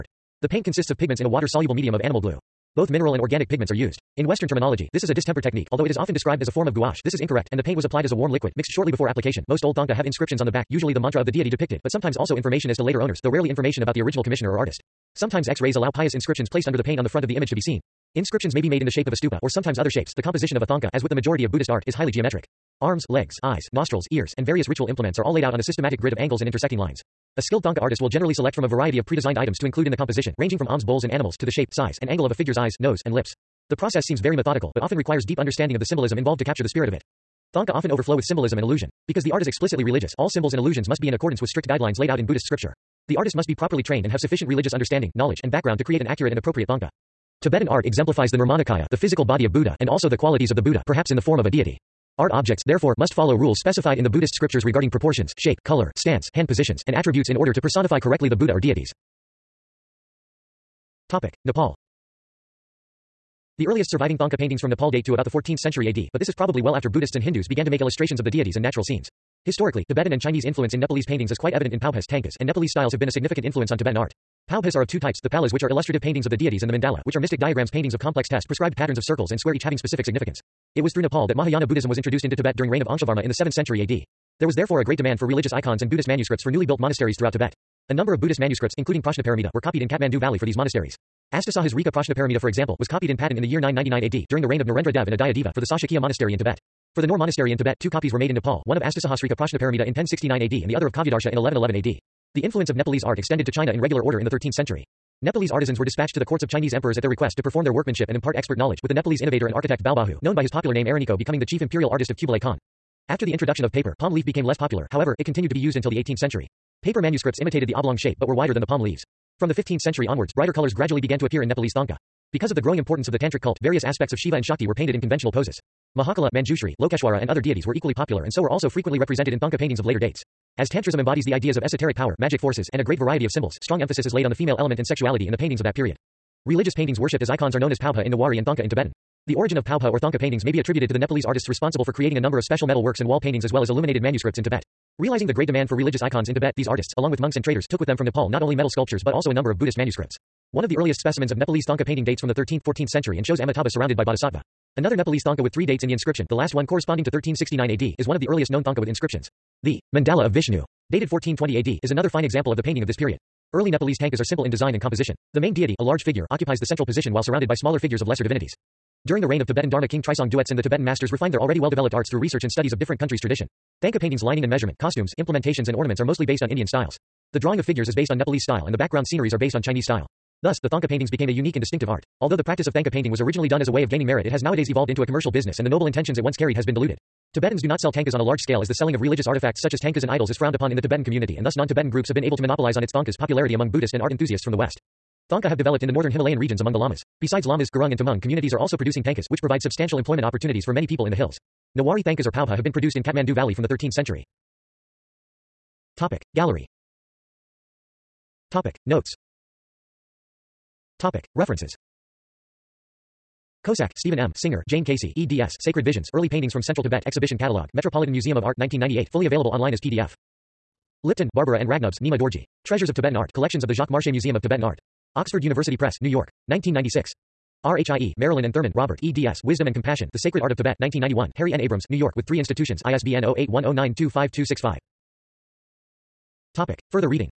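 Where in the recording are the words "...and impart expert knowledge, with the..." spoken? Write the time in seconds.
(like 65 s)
108 s.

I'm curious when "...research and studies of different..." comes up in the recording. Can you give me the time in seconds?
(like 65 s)
172 s.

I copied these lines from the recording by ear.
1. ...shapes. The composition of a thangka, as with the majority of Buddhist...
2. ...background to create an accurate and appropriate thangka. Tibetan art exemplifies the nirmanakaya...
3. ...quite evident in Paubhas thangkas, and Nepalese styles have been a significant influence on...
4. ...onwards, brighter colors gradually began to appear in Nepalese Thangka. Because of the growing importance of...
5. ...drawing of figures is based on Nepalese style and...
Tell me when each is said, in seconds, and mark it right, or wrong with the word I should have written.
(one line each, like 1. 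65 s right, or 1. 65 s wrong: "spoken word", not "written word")
1. 19 s right
2. 45 s right
3. 71 s right
4. 120 s right
5. 177 s right.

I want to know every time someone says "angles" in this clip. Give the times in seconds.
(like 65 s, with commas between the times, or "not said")
26 s, 32 s.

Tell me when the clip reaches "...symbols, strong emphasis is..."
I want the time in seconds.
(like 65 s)
133 s.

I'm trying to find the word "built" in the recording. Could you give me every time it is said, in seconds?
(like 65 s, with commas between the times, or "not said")
86 s.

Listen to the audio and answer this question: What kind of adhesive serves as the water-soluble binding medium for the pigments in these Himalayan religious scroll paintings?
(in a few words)
Animal glue.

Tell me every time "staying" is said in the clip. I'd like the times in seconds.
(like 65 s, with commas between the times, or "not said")
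not said.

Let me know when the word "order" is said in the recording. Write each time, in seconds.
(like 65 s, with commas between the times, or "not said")
57 s, 104 s.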